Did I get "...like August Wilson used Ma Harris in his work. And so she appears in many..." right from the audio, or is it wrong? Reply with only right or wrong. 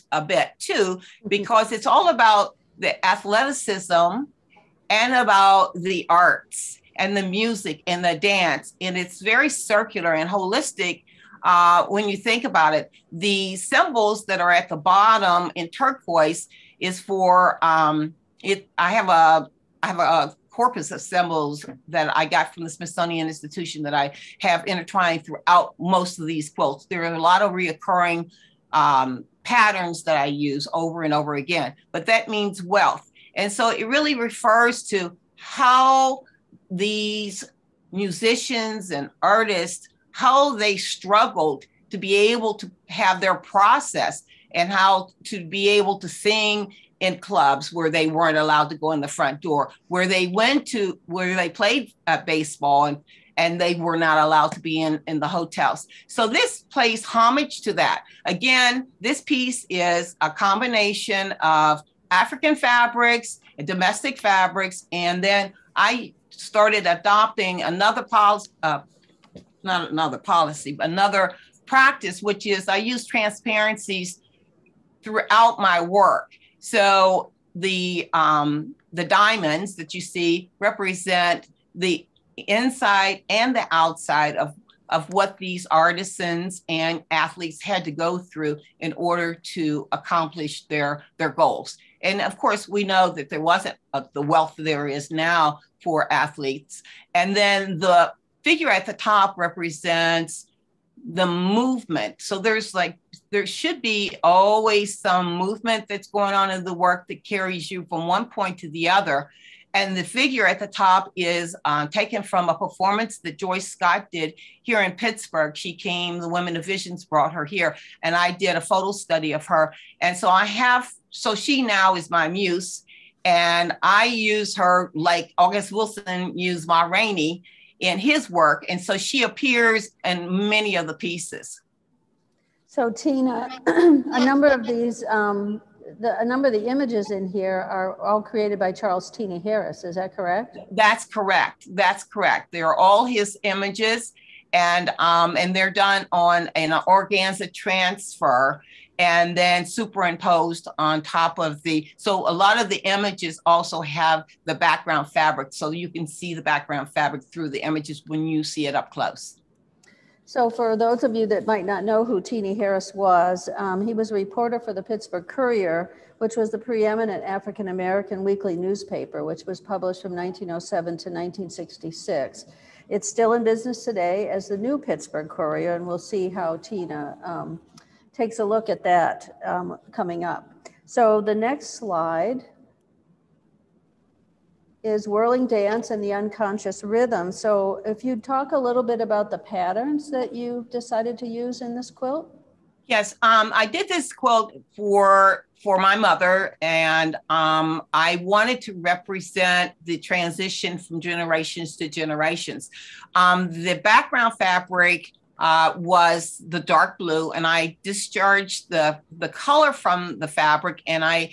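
wrong.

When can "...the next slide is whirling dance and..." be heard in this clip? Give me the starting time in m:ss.
3:01.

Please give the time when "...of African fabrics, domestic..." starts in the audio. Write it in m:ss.
1:01.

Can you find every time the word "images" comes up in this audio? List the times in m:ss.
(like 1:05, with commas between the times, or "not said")
2:16, 2:23, 2:32, 2:37.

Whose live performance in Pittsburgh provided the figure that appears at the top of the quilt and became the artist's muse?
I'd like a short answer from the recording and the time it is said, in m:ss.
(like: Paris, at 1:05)
Joyce Scott, at 1:53.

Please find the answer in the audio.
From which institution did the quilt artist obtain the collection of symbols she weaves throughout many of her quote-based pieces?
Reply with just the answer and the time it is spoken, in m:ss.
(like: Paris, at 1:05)
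Smithsonian Institution, at 0:22.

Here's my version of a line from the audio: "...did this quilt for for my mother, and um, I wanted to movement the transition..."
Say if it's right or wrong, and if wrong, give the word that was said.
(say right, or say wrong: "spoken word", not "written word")
wrong: "represent", not "movement".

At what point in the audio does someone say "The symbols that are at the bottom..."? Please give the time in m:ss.
0:13.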